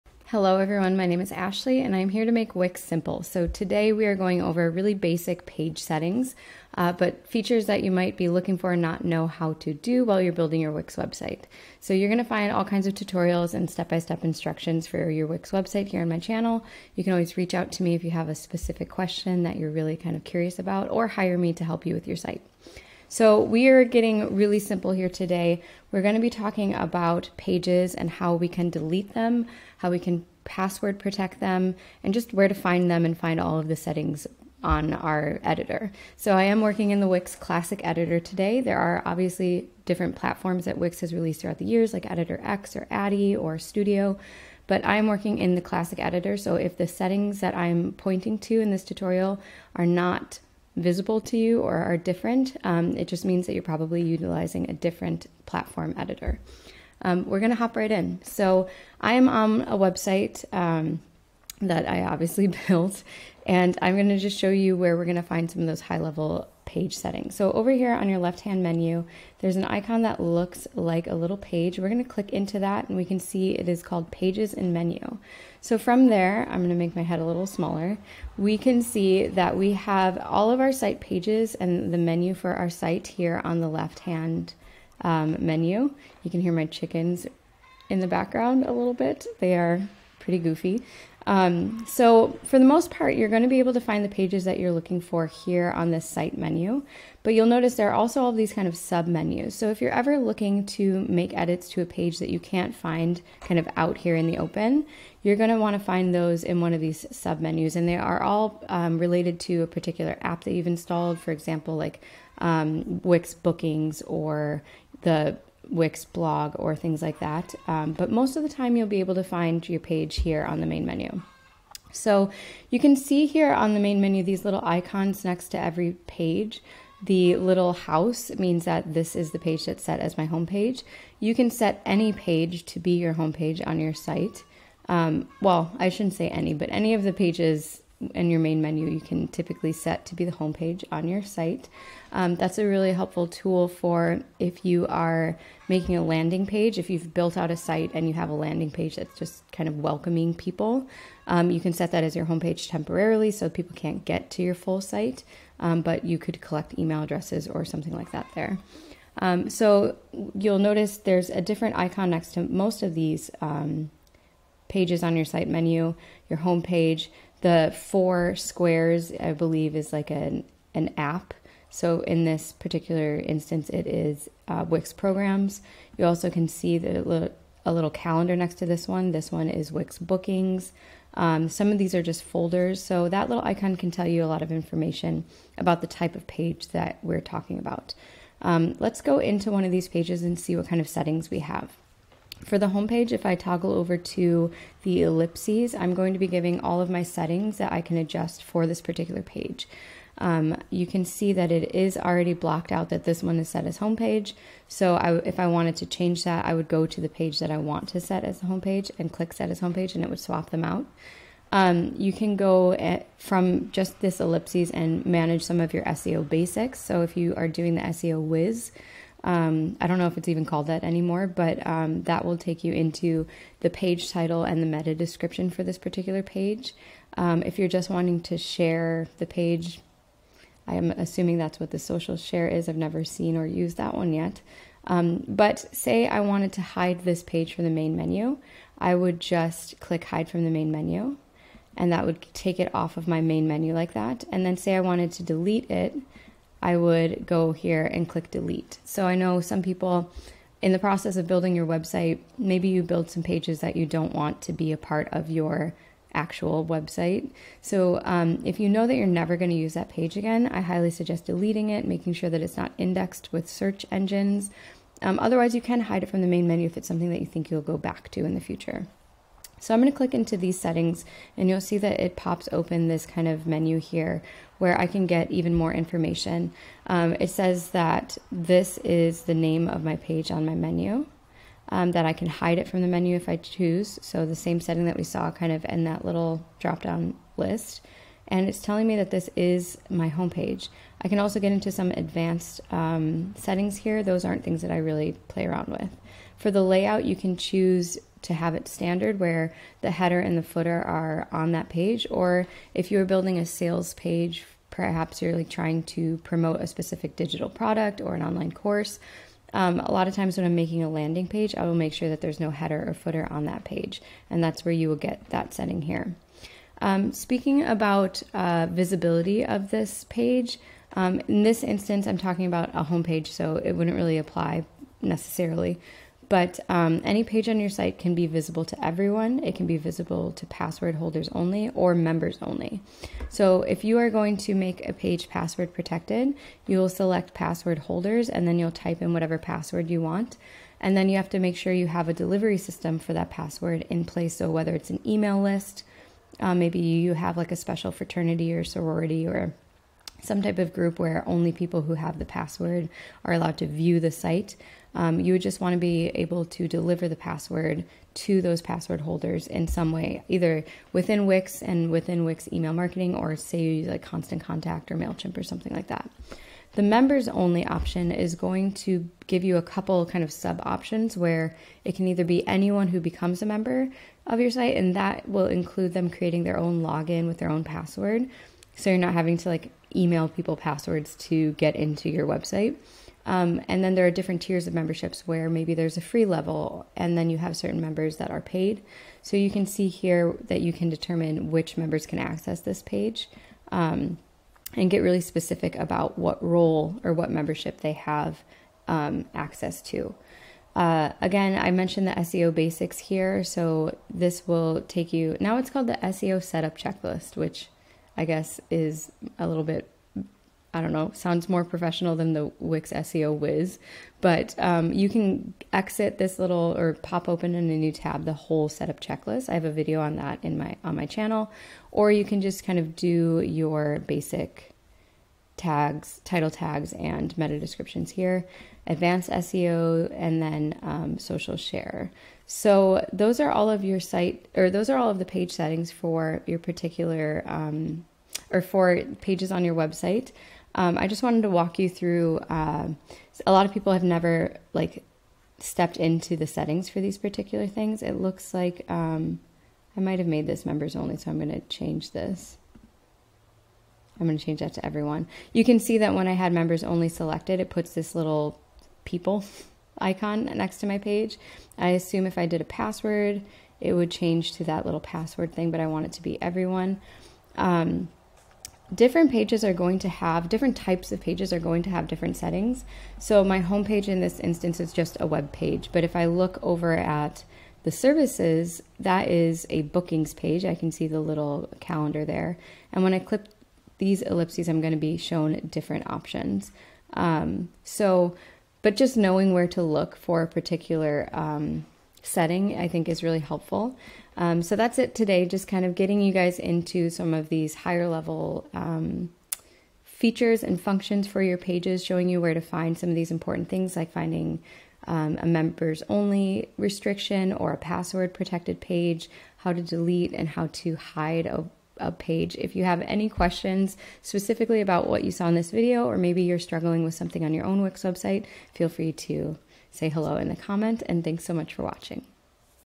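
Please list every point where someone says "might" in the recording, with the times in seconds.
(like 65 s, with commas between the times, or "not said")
7 s, 449 s.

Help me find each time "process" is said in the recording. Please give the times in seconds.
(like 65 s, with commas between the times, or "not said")
250 s.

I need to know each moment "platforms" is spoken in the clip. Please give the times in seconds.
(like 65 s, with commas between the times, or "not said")
40 s, 55 s.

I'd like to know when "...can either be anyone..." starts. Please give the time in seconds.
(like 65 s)
371 s.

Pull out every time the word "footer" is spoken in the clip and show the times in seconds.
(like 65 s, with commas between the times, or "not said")
300 s, 312 s.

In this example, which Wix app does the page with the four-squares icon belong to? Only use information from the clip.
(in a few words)
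Wix programs.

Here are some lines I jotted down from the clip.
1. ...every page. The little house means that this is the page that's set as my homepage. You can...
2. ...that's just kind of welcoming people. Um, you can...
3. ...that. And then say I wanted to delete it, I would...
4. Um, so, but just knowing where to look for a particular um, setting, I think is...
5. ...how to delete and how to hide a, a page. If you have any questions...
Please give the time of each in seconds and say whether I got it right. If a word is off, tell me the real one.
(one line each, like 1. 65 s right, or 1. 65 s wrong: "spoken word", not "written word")
1. 125 s right
2. 148 s right
3. 243 s right
4. 487 s right
5. 509 s right.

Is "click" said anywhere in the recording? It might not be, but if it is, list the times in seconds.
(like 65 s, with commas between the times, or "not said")
72 s, 209 s, 239 s, 248 s, 269 s.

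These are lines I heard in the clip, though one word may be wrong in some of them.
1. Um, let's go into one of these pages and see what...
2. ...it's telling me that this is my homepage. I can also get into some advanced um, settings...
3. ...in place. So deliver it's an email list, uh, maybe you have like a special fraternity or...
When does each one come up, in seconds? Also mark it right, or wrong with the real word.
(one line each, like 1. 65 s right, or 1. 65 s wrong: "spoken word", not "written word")
1. 188 s right
2. 288 s right
3. 343 s wrong: "whether", not "deliver".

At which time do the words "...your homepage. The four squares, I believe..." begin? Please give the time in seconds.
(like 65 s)
166 s.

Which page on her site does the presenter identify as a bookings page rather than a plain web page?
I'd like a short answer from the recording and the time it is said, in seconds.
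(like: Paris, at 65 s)
Services, at 477 s.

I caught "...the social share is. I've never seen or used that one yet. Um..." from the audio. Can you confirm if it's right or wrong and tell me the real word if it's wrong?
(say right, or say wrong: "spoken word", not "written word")
right.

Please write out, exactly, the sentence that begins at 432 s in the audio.
So those are all of your site or those are all of the page settings for your particular.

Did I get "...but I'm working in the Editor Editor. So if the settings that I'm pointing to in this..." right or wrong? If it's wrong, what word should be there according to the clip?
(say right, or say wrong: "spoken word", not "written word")
wrong: "Classic", not "Editor".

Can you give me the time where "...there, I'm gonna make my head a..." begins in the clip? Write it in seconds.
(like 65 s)
76 s.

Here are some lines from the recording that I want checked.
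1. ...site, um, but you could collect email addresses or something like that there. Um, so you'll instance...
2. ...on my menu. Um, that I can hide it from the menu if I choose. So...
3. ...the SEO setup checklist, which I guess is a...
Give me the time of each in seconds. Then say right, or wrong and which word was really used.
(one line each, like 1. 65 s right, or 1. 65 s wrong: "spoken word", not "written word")
1. 154 s wrong: "notice", not "instance"
2. 280 s right
3. 405 s right.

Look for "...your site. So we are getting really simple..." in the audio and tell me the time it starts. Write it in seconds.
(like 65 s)
22 s.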